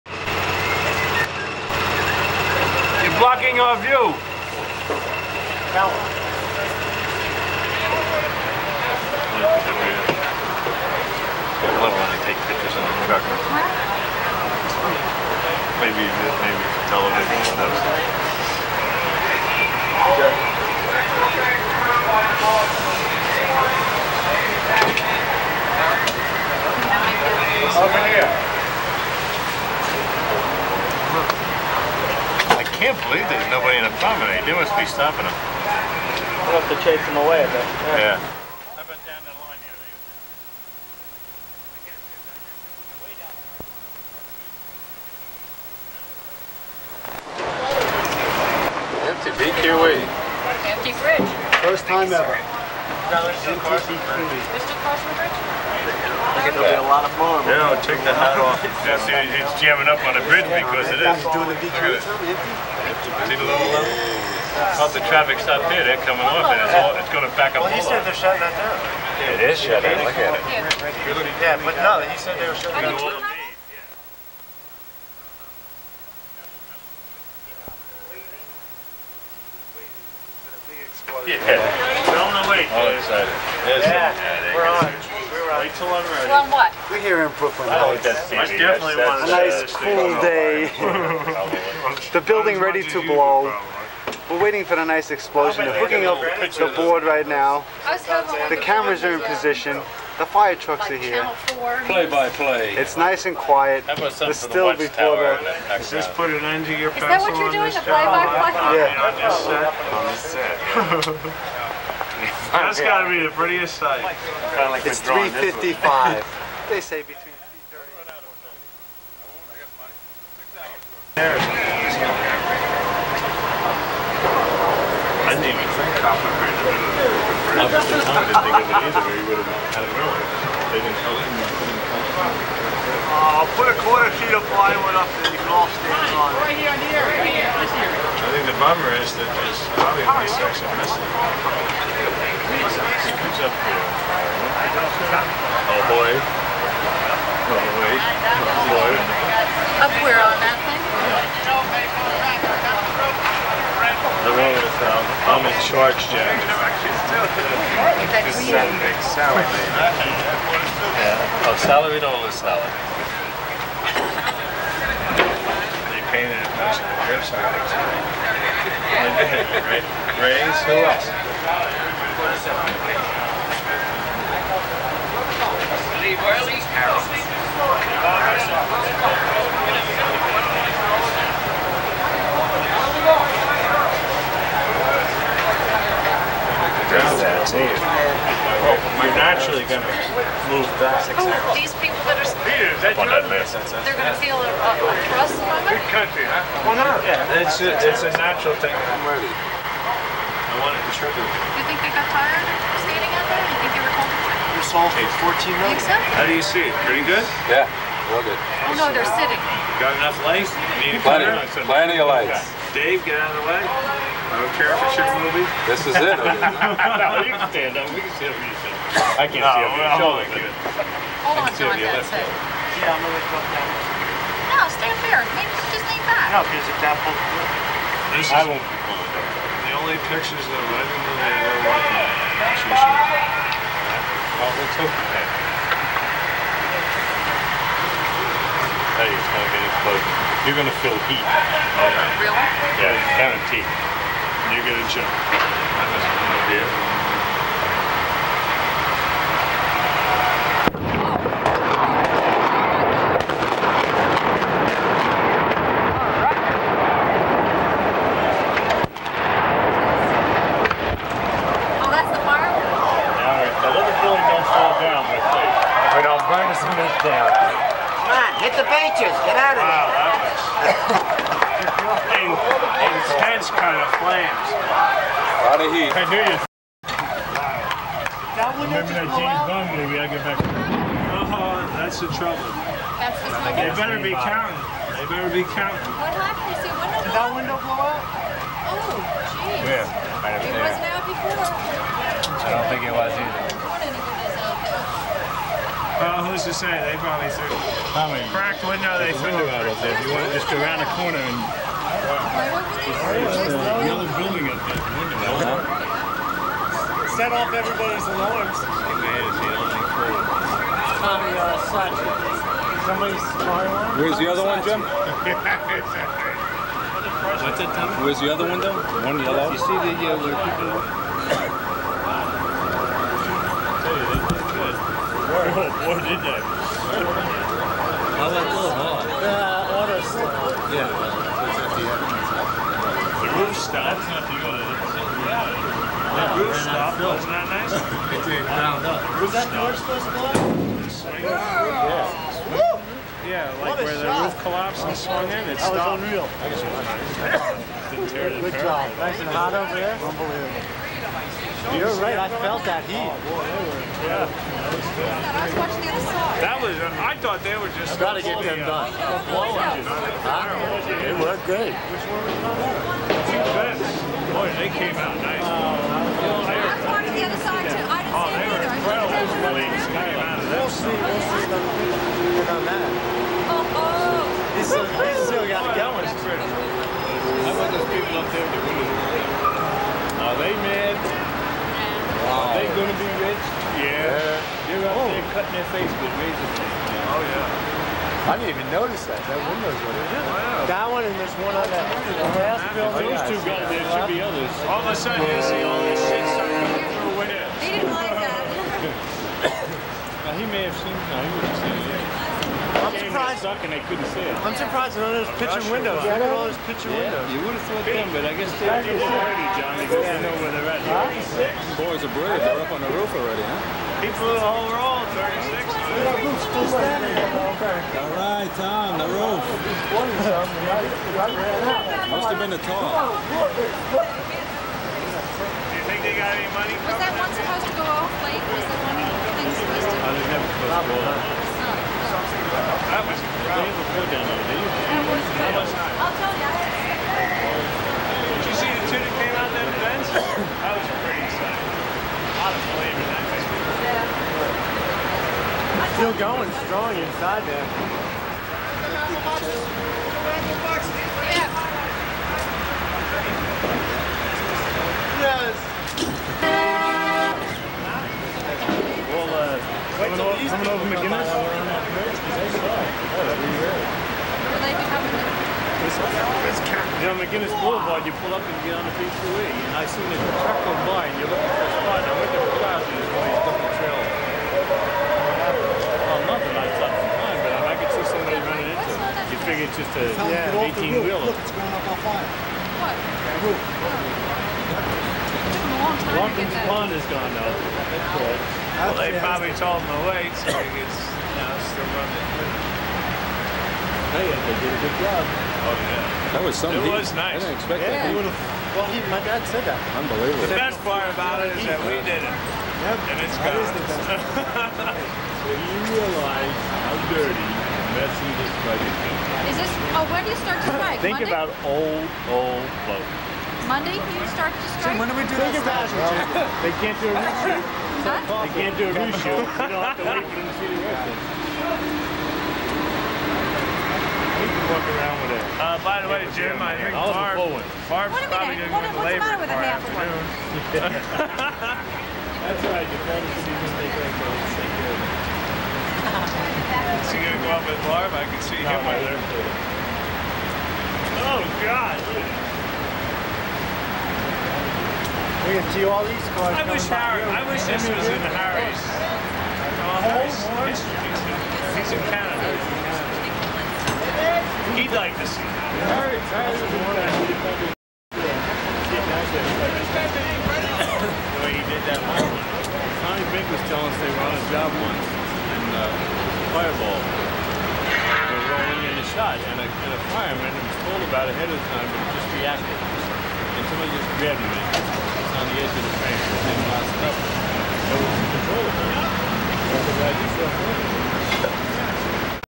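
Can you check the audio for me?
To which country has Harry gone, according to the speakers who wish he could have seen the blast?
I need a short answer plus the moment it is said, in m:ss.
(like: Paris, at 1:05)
Canada, at 9:12.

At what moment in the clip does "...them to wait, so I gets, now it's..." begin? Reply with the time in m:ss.
8:09.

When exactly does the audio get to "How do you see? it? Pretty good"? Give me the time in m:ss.
3:26.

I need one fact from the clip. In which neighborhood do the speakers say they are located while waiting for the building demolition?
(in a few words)
Brooklyn Heights.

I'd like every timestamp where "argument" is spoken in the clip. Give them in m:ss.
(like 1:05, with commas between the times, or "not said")
not said.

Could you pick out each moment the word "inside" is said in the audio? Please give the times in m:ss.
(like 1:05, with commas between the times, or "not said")
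7:26.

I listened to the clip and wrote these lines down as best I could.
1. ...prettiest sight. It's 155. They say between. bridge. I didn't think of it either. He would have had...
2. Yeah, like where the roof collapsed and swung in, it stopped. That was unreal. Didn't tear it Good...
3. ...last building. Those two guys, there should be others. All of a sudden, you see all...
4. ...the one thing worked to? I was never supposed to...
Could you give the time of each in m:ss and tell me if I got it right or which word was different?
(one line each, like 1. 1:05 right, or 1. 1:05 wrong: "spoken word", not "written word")
1. 1:53 wrong: "355", not "155"
2. 5:43 right
3. 6:32 right
4. 7:08 wrong: "supposed", not "worked".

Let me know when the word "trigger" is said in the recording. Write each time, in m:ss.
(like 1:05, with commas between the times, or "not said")
3:20.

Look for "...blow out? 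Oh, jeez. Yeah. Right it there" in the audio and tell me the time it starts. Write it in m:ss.
4:47.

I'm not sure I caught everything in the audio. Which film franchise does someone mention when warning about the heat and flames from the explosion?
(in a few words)
James Bond.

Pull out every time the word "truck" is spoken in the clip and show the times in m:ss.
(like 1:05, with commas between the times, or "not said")
0:13, 1:40, 7:50.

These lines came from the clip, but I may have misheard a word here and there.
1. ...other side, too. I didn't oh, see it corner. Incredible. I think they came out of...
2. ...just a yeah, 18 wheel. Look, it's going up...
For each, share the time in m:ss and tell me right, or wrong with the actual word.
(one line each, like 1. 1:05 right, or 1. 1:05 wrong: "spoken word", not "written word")
1. 6:07 wrong: "either", not "corner"
2. 7:59 right.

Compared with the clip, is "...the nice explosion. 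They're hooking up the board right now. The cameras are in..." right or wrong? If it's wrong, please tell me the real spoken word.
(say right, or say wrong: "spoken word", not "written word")
right.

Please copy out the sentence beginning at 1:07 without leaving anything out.
Well, he said they're shutting that down.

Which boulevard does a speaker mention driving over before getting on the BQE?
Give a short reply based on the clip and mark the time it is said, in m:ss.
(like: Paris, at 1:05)
McGuinness Boulevard, at 7:47.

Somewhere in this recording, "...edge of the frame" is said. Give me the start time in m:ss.
9:35.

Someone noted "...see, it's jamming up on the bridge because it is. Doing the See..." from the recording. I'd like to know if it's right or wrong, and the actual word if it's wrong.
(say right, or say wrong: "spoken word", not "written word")
right.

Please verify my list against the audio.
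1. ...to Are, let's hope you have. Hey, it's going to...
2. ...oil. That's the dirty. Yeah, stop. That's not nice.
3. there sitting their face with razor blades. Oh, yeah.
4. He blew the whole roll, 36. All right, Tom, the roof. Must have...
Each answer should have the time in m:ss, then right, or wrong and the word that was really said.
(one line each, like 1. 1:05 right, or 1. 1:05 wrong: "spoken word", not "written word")
1. 3:51 wrong: "Well", not "Are"
2. 5:34 wrong: "reality", not "dirty"
3. 6:25 wrong: "cutting", not "sitting"
4. 6:54 right.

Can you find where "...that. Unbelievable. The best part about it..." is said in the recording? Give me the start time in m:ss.
8:19.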